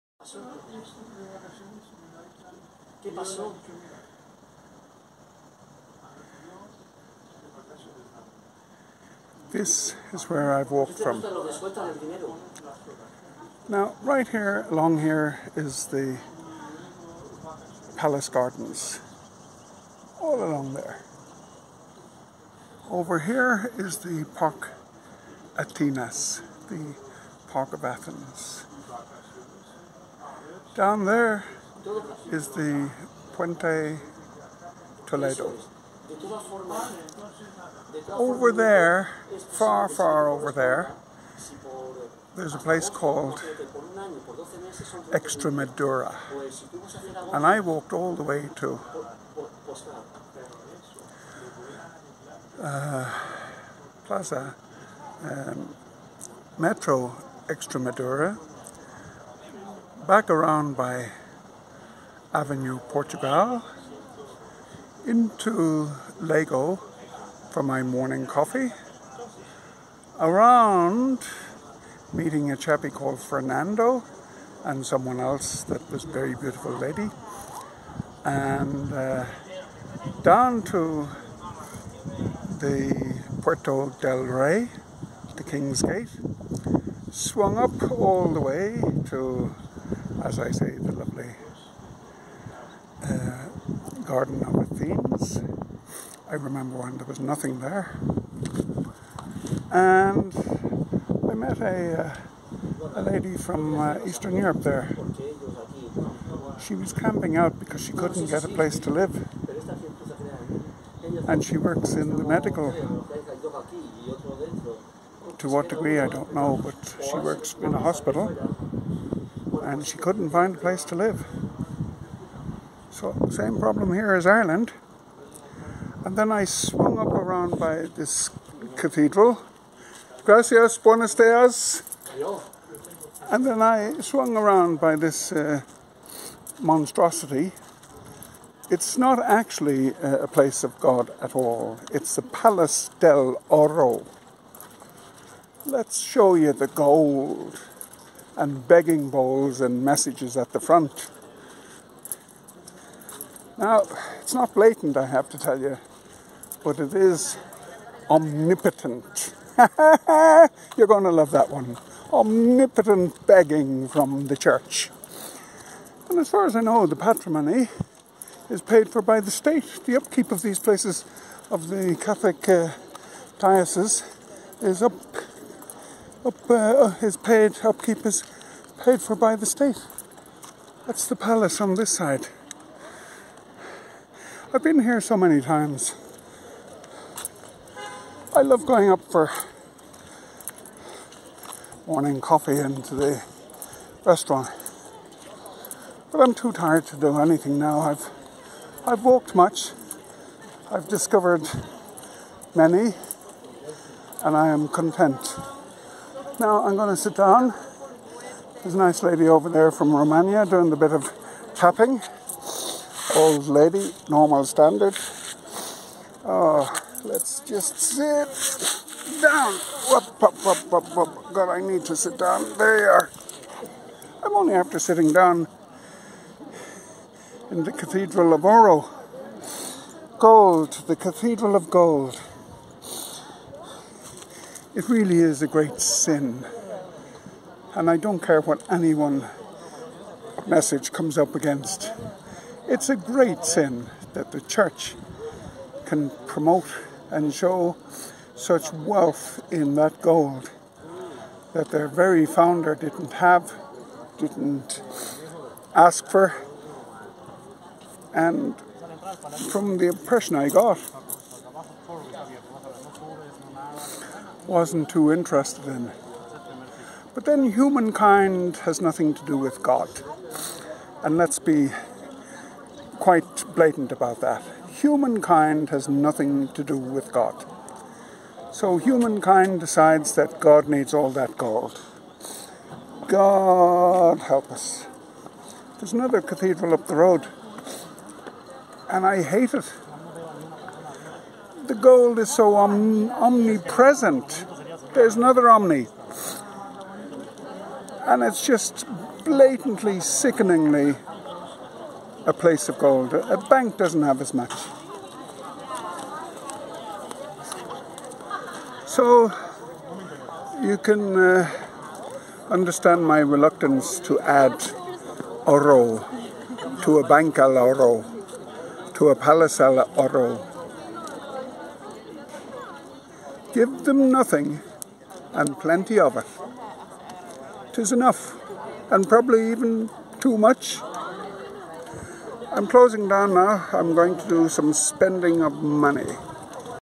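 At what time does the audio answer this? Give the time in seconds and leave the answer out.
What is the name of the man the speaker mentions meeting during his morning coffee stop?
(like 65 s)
73 s.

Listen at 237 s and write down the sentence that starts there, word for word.
And I don't care what anyone message comes up against.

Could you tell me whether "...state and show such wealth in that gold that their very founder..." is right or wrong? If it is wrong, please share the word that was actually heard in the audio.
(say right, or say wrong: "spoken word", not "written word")
wrong: "promote", not "state".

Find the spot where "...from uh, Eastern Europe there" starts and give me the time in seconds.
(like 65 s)
103 s.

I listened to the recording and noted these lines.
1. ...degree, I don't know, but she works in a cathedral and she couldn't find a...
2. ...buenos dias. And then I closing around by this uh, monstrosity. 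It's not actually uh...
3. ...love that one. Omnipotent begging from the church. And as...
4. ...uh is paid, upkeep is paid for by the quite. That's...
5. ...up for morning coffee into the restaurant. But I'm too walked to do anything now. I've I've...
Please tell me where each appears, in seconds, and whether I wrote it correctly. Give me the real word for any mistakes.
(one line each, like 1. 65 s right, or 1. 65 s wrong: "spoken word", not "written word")
1. 115 s wrong: "hospital", not "cathedral"
2. 130 s wrong: "swung", not "closing"
3. 161 s right
4. 176 s wrong: "state", not "quite"
5. 188 s wrong: "tired", not "walked".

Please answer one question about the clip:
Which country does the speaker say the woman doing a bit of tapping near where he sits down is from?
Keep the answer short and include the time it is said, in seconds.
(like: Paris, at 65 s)
Romania, at 209 s.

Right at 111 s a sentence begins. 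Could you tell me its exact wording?
And she works in the medical.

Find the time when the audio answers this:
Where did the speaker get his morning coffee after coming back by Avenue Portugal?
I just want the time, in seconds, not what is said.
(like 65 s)
66 s.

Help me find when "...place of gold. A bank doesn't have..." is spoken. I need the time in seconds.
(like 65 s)
302 s.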